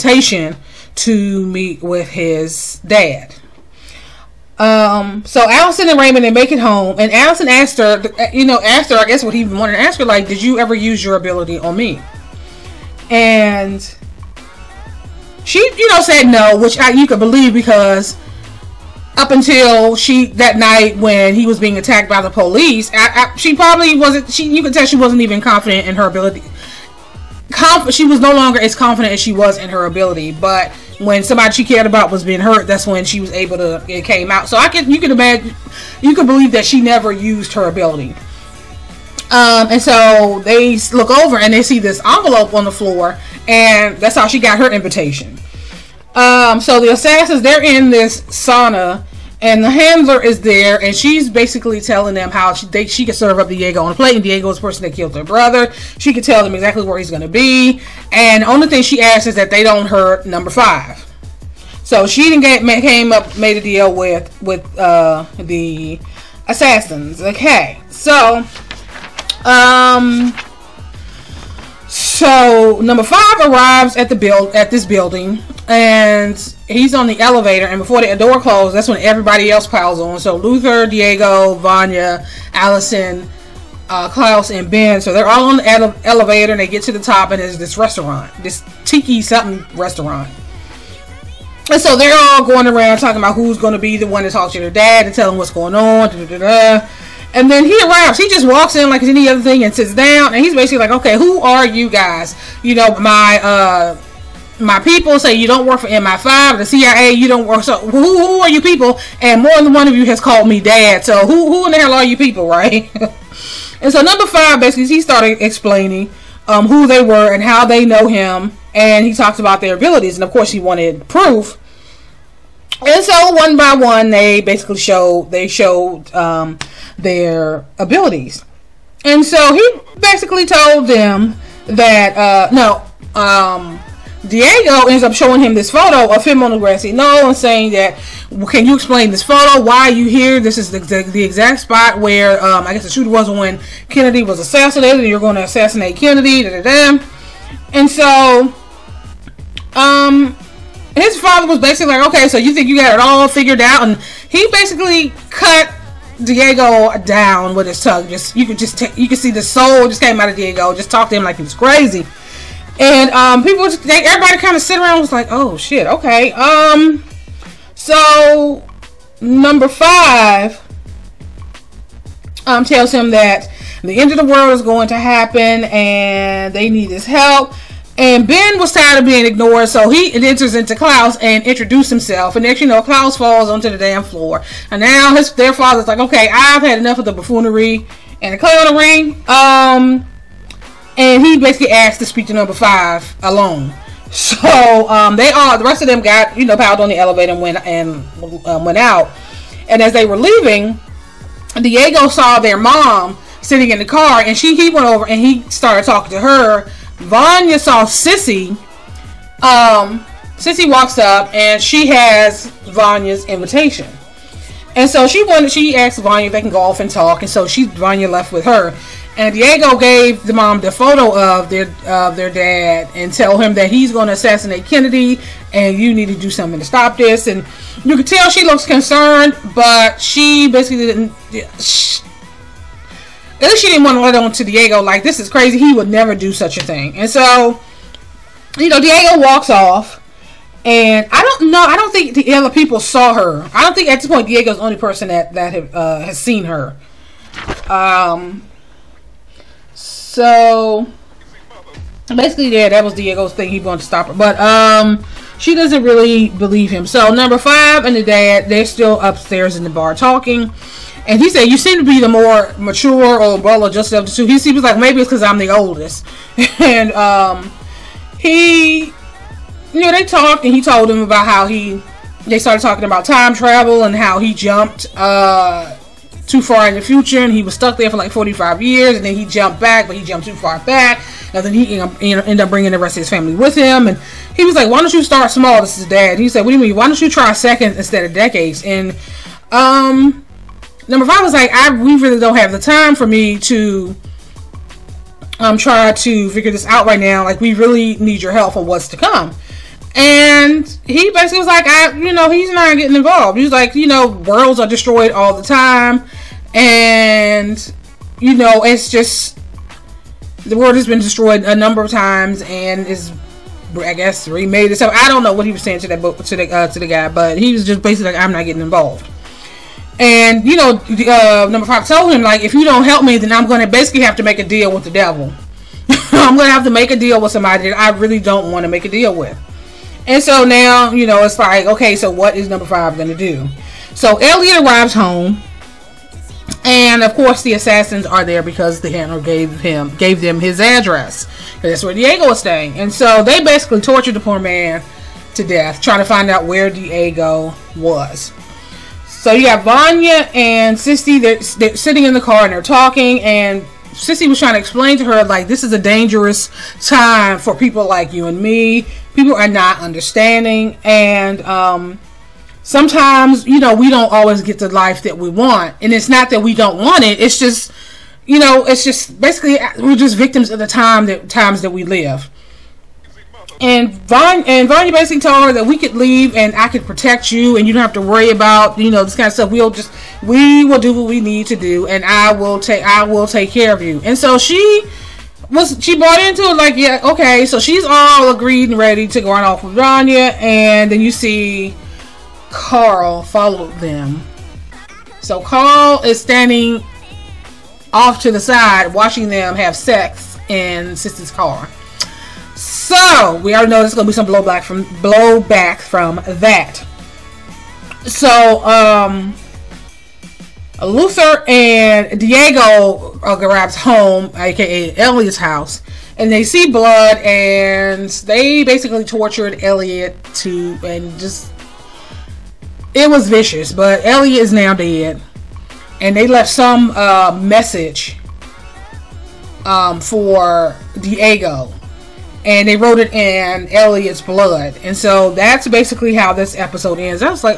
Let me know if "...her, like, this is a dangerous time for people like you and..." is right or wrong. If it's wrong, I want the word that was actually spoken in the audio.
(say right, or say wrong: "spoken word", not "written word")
right.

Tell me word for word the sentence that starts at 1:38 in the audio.
He just walks in like any other thing and sits down.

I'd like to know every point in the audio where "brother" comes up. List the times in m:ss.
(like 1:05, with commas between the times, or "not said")
0:55, 4:23.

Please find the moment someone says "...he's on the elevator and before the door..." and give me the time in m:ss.
1:16.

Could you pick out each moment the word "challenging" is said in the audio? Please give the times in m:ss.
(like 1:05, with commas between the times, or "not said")
not said.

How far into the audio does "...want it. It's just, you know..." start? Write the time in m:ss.
6:06.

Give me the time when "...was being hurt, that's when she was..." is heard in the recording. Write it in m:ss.
0:32.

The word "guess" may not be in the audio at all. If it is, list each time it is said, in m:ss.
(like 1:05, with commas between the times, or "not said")
0:09, 2:22, 5:13.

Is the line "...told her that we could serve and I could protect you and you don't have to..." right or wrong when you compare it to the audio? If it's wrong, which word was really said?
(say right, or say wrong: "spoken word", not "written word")
wrong: "leave", not "serve".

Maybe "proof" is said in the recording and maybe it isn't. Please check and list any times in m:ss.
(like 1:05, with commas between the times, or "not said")
2:01.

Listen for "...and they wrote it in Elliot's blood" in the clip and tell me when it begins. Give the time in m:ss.
7:12.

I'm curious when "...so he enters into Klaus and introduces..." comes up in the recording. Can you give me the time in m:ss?
2:59.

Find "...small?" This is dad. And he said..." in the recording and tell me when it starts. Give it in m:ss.
4:45.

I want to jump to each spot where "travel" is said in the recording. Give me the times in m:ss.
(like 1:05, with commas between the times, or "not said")
4:33.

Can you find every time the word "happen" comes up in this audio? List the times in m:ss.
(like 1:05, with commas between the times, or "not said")
2:54.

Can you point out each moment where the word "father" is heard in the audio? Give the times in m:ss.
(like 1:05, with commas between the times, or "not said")
2:31, 3:05.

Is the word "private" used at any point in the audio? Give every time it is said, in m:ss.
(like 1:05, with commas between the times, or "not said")
not said.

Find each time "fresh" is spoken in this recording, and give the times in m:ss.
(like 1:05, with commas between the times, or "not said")
not said.